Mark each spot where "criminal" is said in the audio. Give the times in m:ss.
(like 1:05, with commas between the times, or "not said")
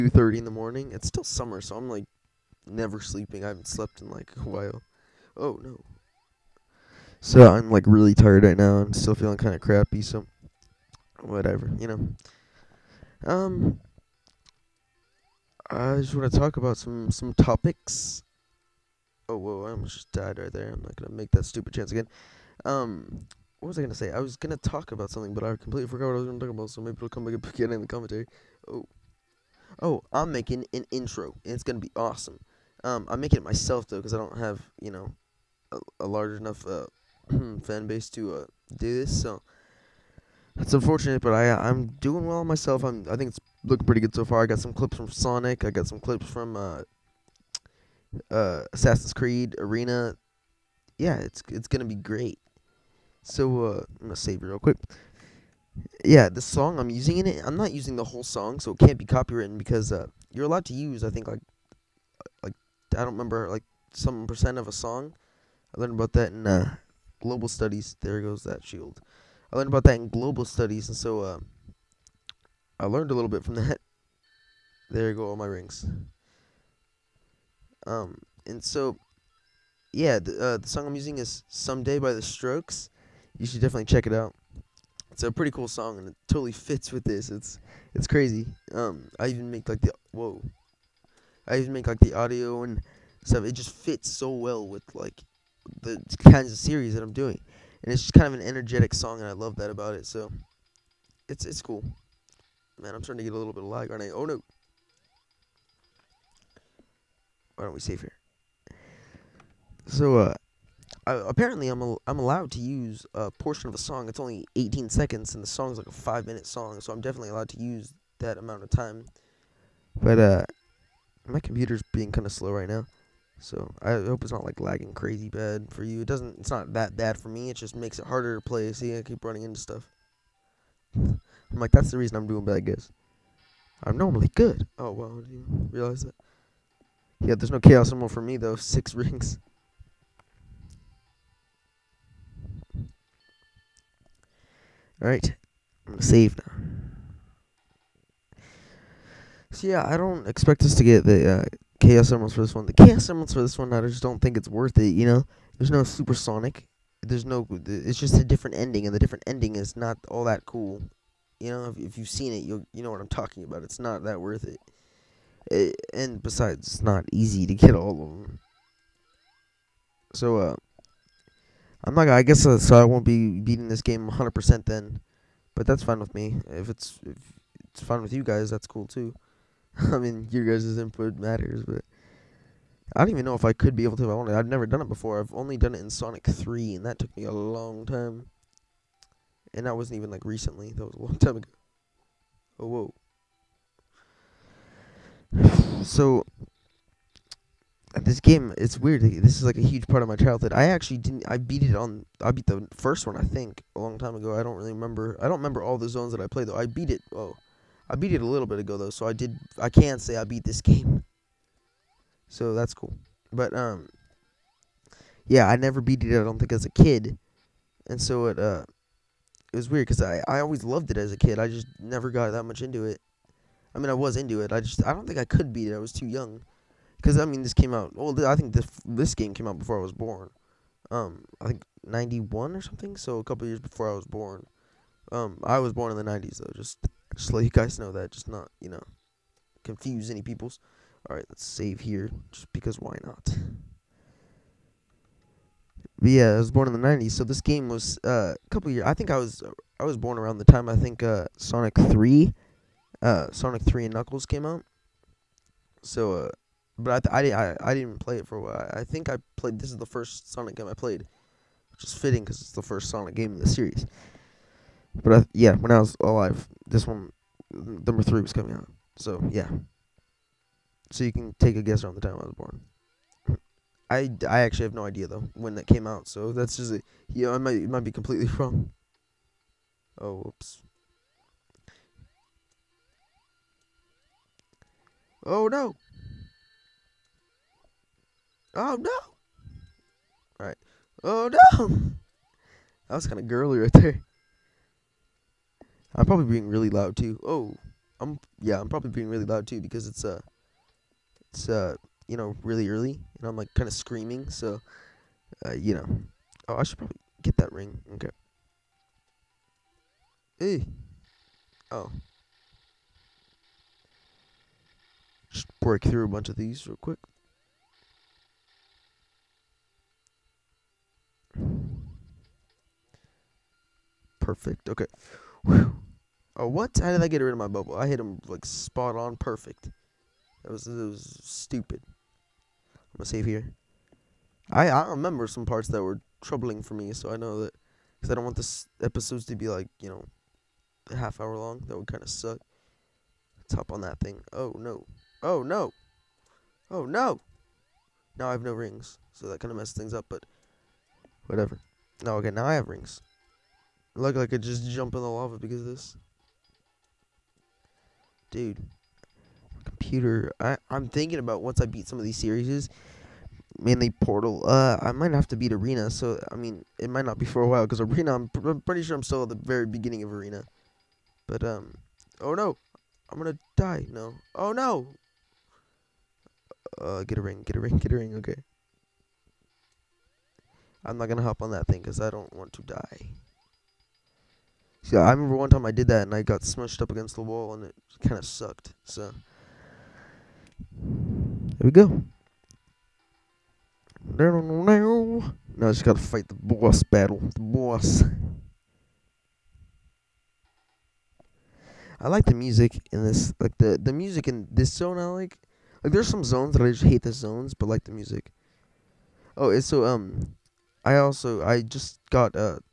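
not said.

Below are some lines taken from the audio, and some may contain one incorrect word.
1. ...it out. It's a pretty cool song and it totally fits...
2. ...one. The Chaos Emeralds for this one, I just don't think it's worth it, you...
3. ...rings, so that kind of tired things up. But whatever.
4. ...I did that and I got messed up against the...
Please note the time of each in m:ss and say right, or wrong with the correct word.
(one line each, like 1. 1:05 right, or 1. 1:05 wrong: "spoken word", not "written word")
1. 1:24 right
2. 2:32 right
3. 5:48 wrong: "messed", not "tired"
4. 6:25 wrong: "smushed", not "messed".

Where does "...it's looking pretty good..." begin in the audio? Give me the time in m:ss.
0:43.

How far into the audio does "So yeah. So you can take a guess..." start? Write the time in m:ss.
4:28.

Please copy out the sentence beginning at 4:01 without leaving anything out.
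All right, let's save here just because why not?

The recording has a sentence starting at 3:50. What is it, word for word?
Um, I think ninety one or something.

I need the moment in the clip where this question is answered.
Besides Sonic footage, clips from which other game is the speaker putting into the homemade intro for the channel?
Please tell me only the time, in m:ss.
0:48.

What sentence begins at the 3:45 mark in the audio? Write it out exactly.
I was too young because I mean this came out.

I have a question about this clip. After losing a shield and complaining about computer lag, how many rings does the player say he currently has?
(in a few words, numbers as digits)
6.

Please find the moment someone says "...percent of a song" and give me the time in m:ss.
1:04.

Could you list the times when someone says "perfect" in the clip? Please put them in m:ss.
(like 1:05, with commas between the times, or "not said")
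5:24, 5:29.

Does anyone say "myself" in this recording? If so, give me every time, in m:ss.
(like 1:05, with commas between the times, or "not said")
0:33, 0:42.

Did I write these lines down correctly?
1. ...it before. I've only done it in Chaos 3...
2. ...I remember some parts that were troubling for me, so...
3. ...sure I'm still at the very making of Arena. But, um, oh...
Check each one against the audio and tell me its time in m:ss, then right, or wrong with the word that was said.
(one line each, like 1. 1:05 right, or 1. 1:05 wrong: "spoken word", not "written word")
1. 3:04 wrong: "Sonic", not "Chaos"
2. 5:34 right
3. 6:08 wrong: "beginning", not "making".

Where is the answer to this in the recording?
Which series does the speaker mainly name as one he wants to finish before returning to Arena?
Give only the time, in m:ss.
6:03.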